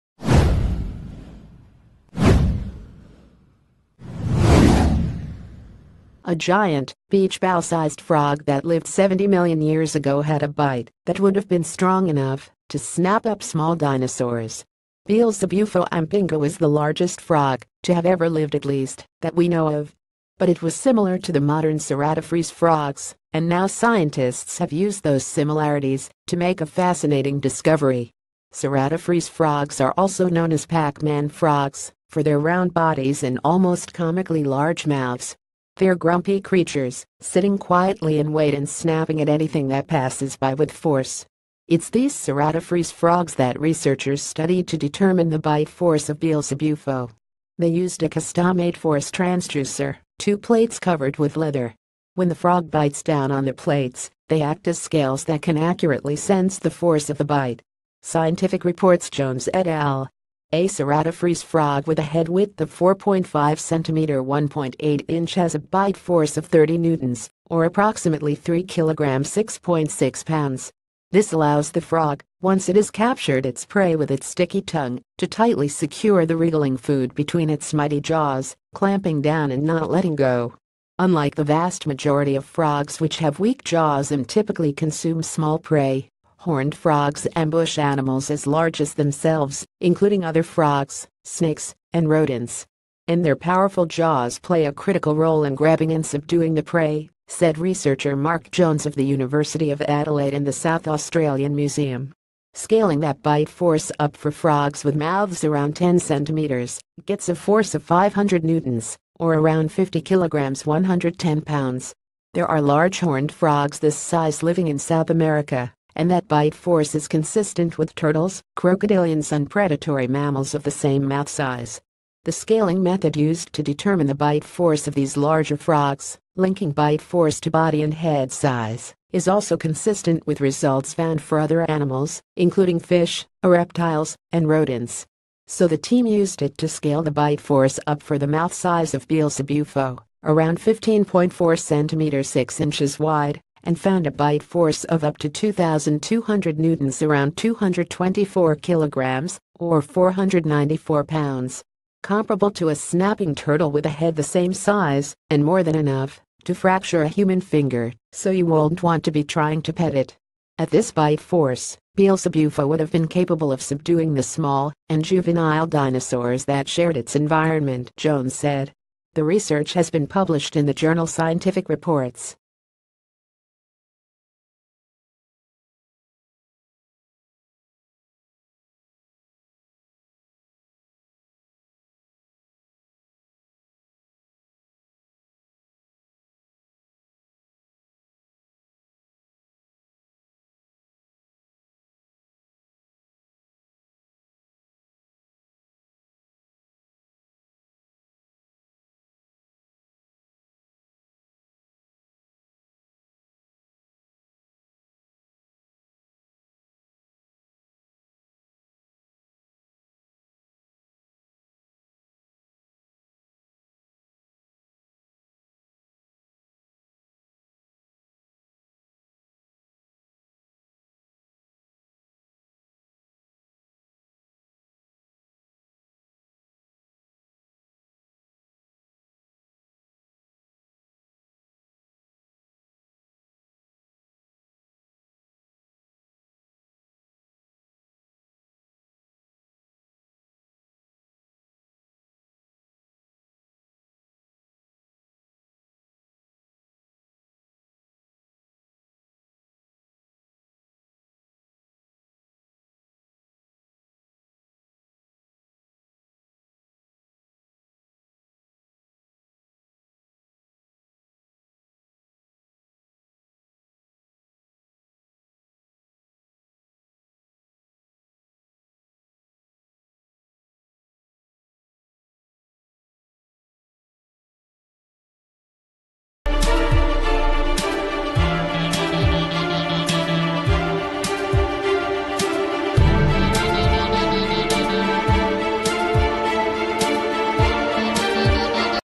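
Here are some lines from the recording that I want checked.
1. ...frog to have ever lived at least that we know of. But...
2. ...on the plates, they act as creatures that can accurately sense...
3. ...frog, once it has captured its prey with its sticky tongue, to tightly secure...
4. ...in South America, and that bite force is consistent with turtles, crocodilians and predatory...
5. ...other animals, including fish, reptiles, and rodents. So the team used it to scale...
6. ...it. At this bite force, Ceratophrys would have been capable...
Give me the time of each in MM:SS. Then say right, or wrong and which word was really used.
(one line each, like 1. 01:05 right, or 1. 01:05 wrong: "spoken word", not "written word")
1. 00:17 right
2. 00:53 wrong: "scales", not "creatures"
3. 01:11 right
4. 01:54 right
5. 02:11 right
6. 02:39 wrong: "Beelzebufo", not "Ceratophrys".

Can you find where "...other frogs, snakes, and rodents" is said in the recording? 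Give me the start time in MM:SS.
01:30.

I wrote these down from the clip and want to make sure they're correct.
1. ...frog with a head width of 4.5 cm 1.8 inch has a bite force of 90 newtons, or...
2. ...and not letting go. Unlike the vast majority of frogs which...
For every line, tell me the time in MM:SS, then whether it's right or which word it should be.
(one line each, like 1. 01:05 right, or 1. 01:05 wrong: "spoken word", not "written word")
1. 01:01 wrong: "30", not "90"
2. 01:19 right.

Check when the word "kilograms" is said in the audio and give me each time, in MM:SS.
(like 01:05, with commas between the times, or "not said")
01:50, 02:28.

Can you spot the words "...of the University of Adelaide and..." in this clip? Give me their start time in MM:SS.
01:38.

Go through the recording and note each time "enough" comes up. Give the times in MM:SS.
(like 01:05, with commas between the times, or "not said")
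00:12, 02:35.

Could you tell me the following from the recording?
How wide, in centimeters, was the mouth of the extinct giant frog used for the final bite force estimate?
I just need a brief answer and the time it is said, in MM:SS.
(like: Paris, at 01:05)
15.4 centimeters, at 02:20.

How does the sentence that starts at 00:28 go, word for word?
Ceratophrys frogs are also known as Pac-Man frogs for their round bodies and almost comically large mouths.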